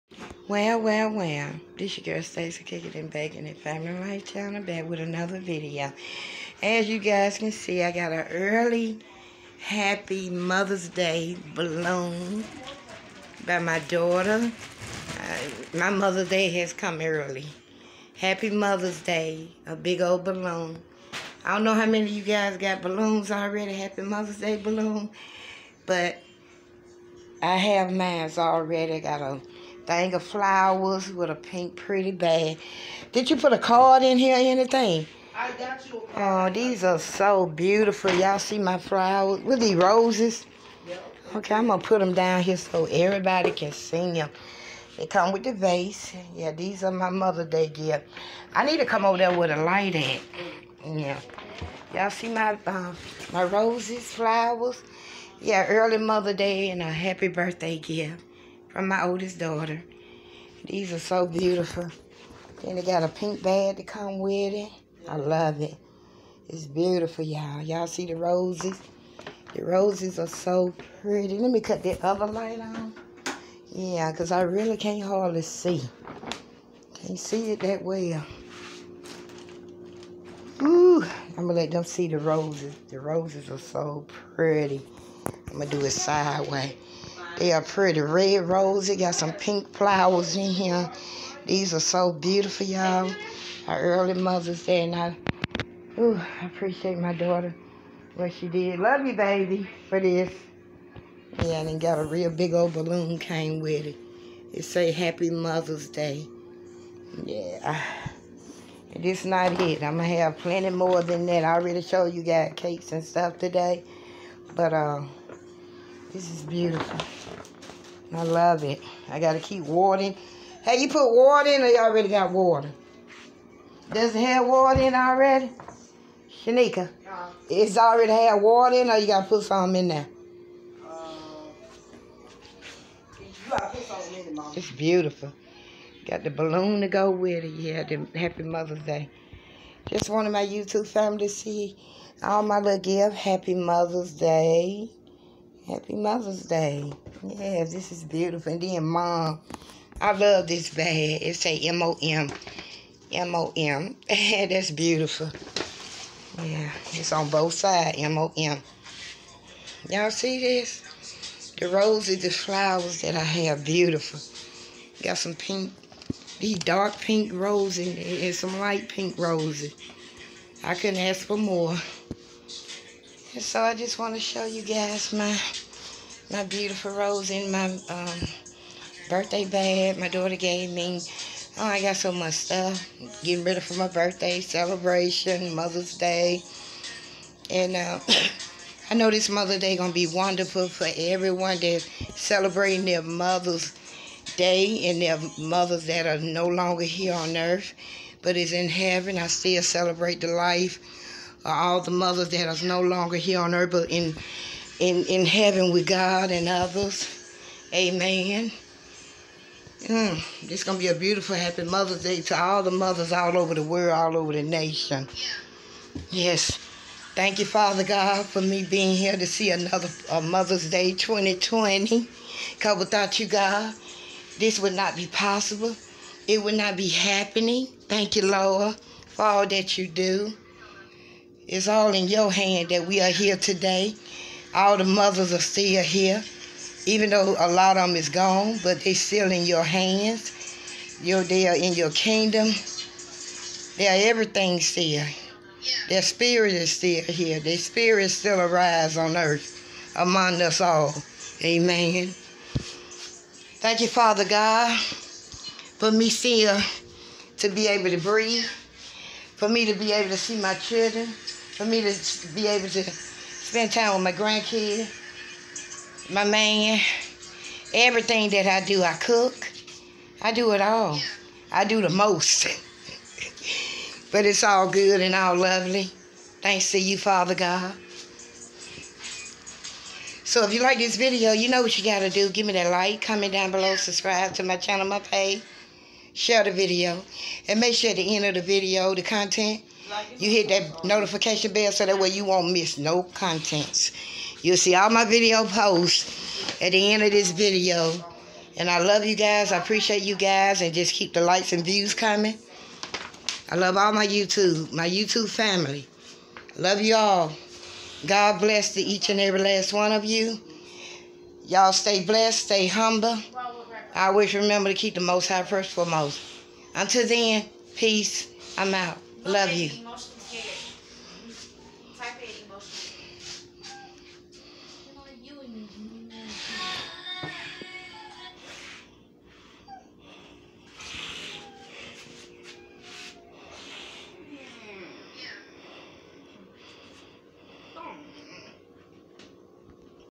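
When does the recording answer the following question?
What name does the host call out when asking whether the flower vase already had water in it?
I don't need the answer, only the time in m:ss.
2:06.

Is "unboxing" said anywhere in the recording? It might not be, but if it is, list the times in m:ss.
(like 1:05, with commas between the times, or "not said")
not said.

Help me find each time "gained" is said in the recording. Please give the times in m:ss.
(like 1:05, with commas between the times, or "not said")
not said.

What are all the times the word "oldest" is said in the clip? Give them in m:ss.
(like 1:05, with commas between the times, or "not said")
0:59.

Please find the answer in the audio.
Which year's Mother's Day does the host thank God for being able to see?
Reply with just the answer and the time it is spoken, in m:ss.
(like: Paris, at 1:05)
2020, at 3:40.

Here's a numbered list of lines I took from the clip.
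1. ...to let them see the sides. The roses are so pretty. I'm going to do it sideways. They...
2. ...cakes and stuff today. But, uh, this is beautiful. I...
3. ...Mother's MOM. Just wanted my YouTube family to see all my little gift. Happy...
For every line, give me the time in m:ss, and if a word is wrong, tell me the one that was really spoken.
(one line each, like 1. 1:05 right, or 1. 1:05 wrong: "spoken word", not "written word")
1. 1:21 wrong: "roses", not "sides"
2. 1:52 right
3. 2:18 wrong: "Day", not "MOM".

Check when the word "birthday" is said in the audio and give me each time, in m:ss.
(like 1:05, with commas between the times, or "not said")
0:57, 2:59, 3:03.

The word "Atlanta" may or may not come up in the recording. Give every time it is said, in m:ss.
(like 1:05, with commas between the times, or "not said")
not said.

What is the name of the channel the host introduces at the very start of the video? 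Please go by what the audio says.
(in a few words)
Stacey Cooking and Baking and Family Life Channel.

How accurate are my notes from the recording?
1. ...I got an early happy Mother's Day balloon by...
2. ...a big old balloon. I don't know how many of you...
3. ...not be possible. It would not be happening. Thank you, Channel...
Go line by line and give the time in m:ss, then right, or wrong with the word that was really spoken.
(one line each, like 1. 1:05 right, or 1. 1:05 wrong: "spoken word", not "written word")
1. 0:07 right
2. 0:19 right
3. 3:44 wrong: "Lord", not "Channel".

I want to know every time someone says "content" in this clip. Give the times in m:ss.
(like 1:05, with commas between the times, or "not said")
4:49, 4:53.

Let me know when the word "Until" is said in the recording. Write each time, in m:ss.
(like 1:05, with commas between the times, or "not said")
5:16.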